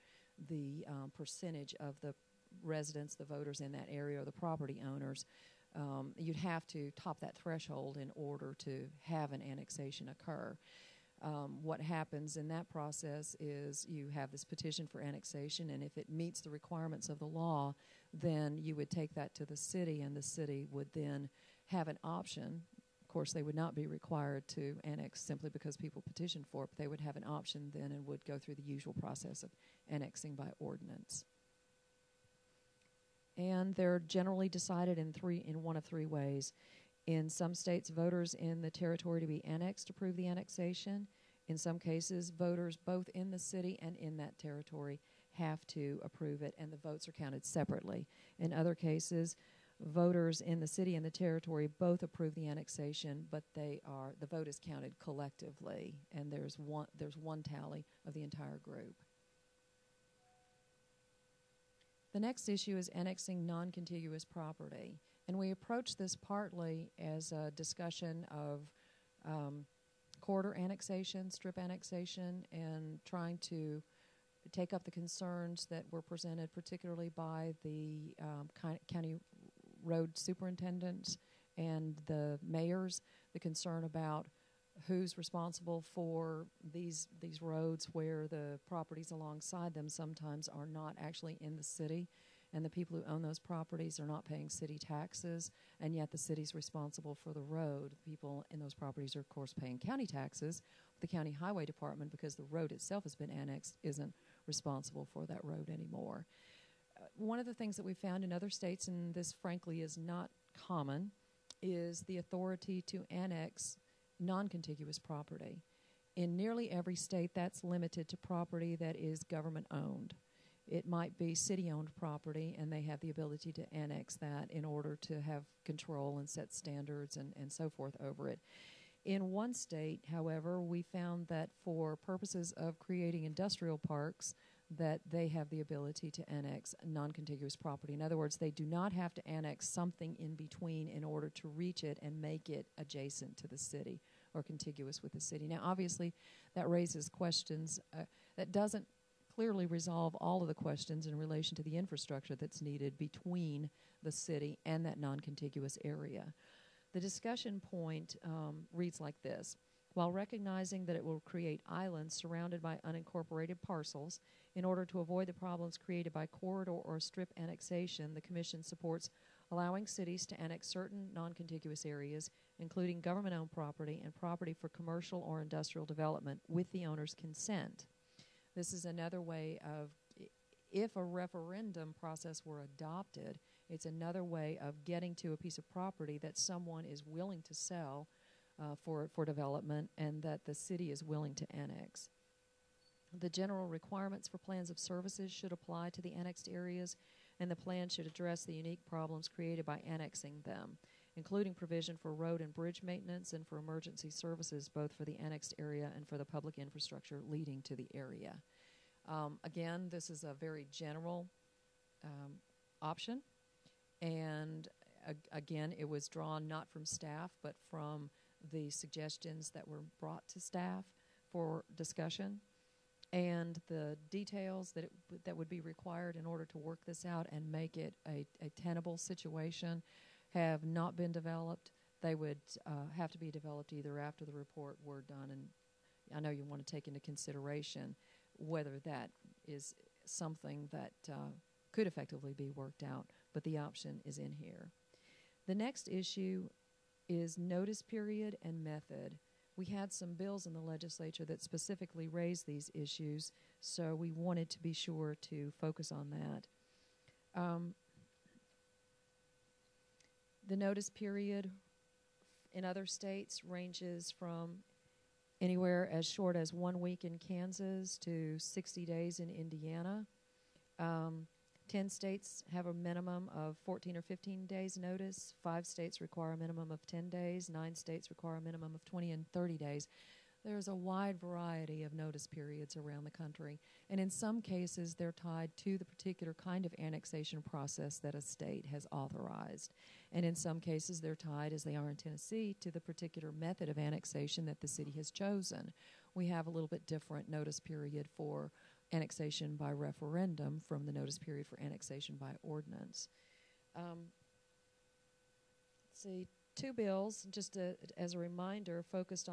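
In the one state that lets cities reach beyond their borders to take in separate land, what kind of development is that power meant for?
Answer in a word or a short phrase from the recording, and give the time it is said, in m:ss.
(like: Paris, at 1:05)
industrial parks, at 2:13.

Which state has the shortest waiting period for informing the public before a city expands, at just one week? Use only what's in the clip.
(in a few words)
Kansas.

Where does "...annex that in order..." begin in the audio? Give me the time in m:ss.
2:03.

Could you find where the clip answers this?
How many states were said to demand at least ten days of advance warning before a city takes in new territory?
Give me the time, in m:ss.
4:35.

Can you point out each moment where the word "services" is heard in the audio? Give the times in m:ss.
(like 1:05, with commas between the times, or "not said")
3:14, 3:24.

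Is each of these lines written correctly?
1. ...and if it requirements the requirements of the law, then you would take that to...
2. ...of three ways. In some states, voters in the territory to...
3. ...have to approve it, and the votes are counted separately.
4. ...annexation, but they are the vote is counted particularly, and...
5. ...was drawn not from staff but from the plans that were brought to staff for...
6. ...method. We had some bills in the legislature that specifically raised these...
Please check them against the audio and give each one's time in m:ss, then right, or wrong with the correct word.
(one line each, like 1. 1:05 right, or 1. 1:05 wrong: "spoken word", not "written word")
1. 0:15 wrong: "meets", not "requirements"
2. 0:35 right
3. 0:45 right
4. 0:52 wrong: "collectively", not "particularly"
5. 3:35 wrong: "suggestions", not "plans"
6. 4:08 right.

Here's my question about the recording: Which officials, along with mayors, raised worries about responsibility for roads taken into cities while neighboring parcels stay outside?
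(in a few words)
county road superintendents.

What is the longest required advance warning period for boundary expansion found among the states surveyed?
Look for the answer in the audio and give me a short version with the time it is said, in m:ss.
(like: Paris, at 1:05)
60 days, at 4:28.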